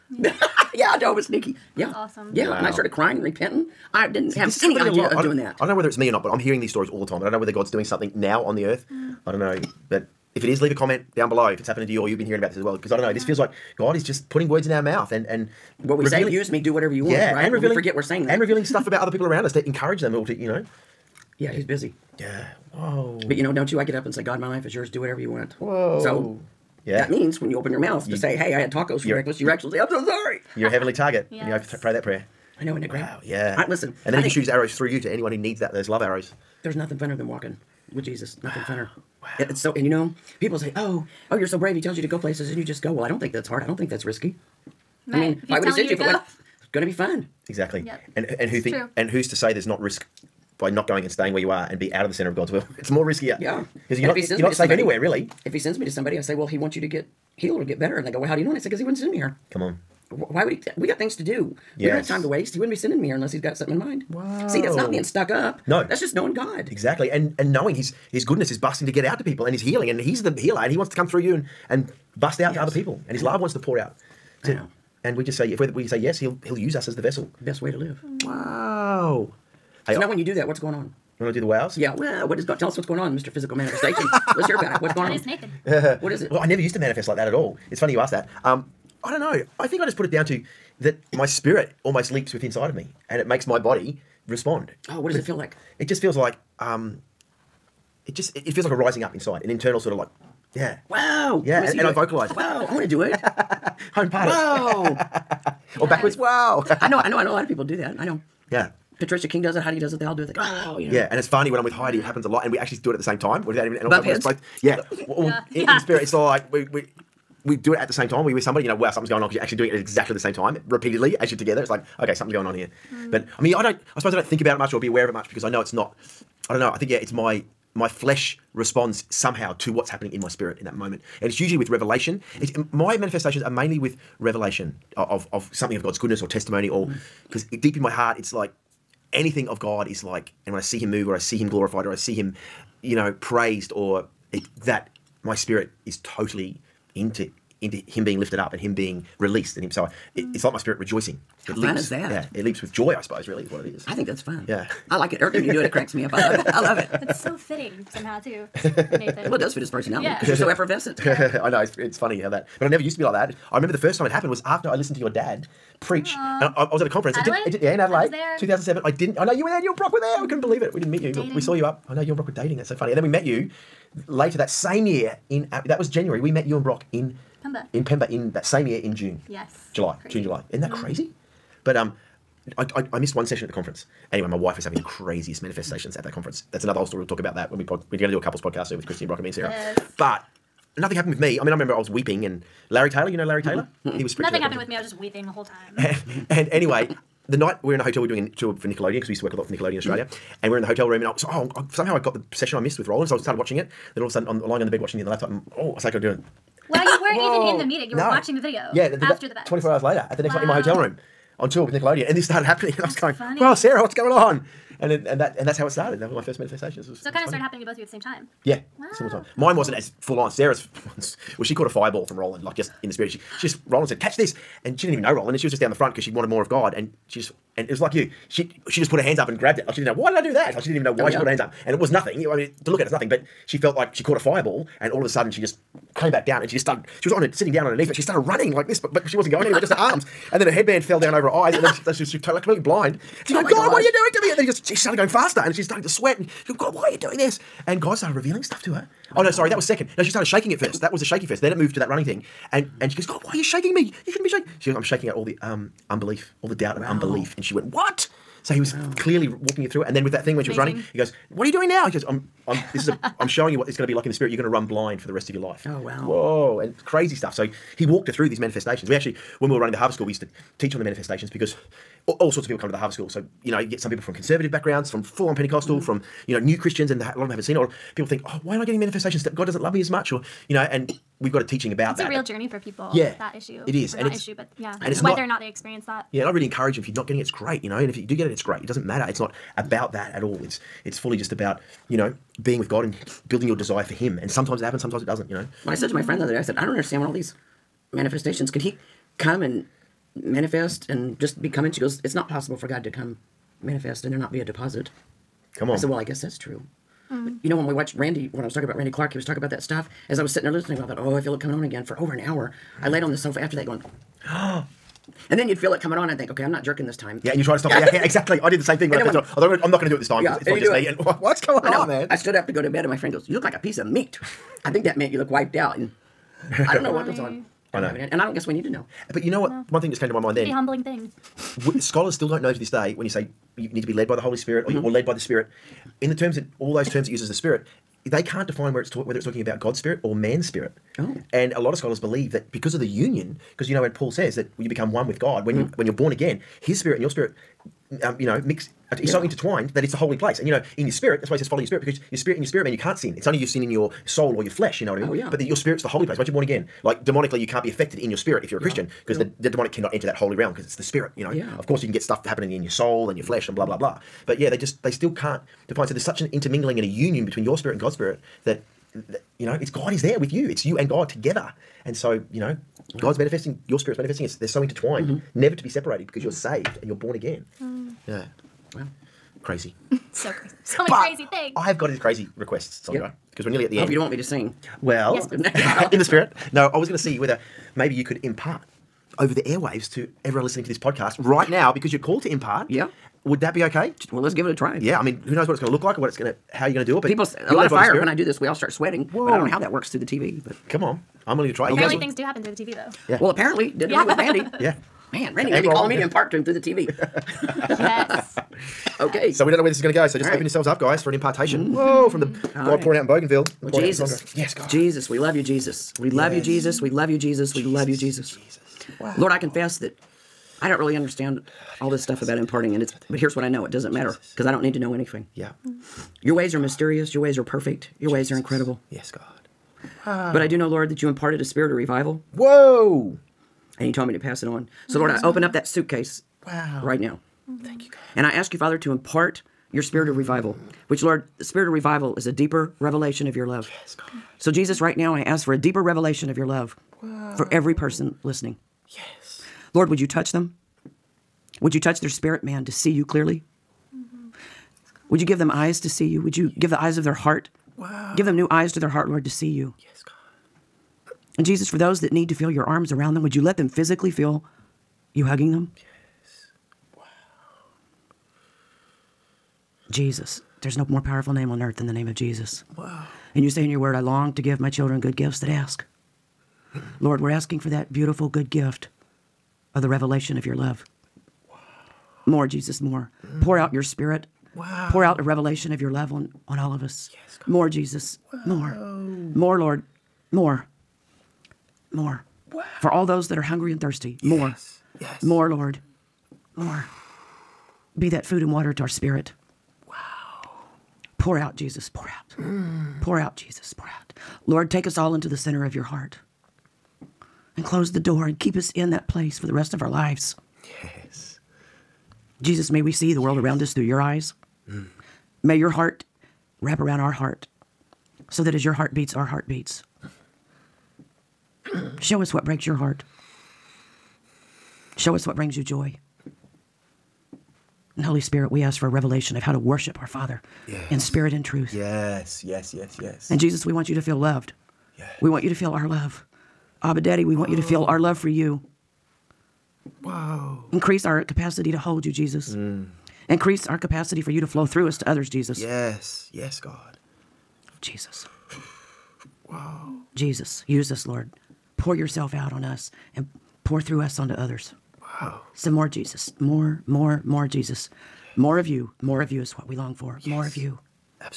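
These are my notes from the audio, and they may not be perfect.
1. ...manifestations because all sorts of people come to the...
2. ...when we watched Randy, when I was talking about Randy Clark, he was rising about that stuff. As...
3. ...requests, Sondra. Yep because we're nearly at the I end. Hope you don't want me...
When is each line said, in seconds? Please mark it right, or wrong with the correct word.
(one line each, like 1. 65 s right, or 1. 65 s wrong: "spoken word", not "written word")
1. 270 s right
2. 307 s wrong: "talking", not "rising"
3. 382 s right.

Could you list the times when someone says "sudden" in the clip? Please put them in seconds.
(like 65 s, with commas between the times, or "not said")
204 s, 235 s.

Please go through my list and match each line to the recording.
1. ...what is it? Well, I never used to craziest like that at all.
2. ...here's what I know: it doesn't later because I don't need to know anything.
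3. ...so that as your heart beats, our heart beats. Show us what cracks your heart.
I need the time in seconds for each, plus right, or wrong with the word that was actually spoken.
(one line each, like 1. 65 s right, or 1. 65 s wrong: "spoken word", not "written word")
1. 86 s wrong: "manifest", not "craziest"
2. 423 s wrong: "matter", not "later"
3. 518 s wrong: "breaks", not "cracks".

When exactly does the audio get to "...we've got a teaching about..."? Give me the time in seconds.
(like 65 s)
281 s.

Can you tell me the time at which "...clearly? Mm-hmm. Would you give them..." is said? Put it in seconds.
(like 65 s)
453 s.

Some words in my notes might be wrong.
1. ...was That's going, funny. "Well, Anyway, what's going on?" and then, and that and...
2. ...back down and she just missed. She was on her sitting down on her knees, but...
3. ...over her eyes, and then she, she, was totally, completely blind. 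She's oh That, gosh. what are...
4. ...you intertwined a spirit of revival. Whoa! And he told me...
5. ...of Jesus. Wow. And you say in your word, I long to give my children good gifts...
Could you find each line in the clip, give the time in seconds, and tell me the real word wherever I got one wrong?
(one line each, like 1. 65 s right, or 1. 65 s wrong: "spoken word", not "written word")
1. 212 s wrong: "Sarah", not "Anyway"
2. 236 s wrong: "started", not "missed"
3. 241 s wrong: "God", not "That"
4. 431 s wrong: "imparted", not "intertwined"
5. 472 s right.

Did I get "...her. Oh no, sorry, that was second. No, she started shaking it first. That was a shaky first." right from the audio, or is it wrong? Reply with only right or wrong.
right.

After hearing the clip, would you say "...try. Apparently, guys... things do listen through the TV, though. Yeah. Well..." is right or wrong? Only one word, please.
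wrong.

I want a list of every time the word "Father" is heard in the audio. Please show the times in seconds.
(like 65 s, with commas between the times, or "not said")
438 s, 530 s.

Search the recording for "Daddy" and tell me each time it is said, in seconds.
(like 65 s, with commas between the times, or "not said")
537 s.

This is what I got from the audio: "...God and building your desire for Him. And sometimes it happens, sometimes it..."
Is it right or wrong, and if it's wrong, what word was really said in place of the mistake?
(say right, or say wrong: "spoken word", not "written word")
right.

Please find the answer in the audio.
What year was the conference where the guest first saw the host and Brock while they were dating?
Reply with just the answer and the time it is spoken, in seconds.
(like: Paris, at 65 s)
2007, at 168 s.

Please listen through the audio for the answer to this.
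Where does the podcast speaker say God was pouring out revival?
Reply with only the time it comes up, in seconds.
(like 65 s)
413 s.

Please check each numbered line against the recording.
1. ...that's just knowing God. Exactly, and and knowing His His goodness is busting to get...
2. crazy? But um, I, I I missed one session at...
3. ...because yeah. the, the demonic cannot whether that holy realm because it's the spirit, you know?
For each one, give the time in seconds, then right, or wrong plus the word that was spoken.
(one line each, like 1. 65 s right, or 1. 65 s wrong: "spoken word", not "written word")
1. 65 s right
2. 180 s right
3. 359 s wrong: "enter", not "whether".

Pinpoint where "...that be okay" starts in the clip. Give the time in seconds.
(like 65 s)
393 s.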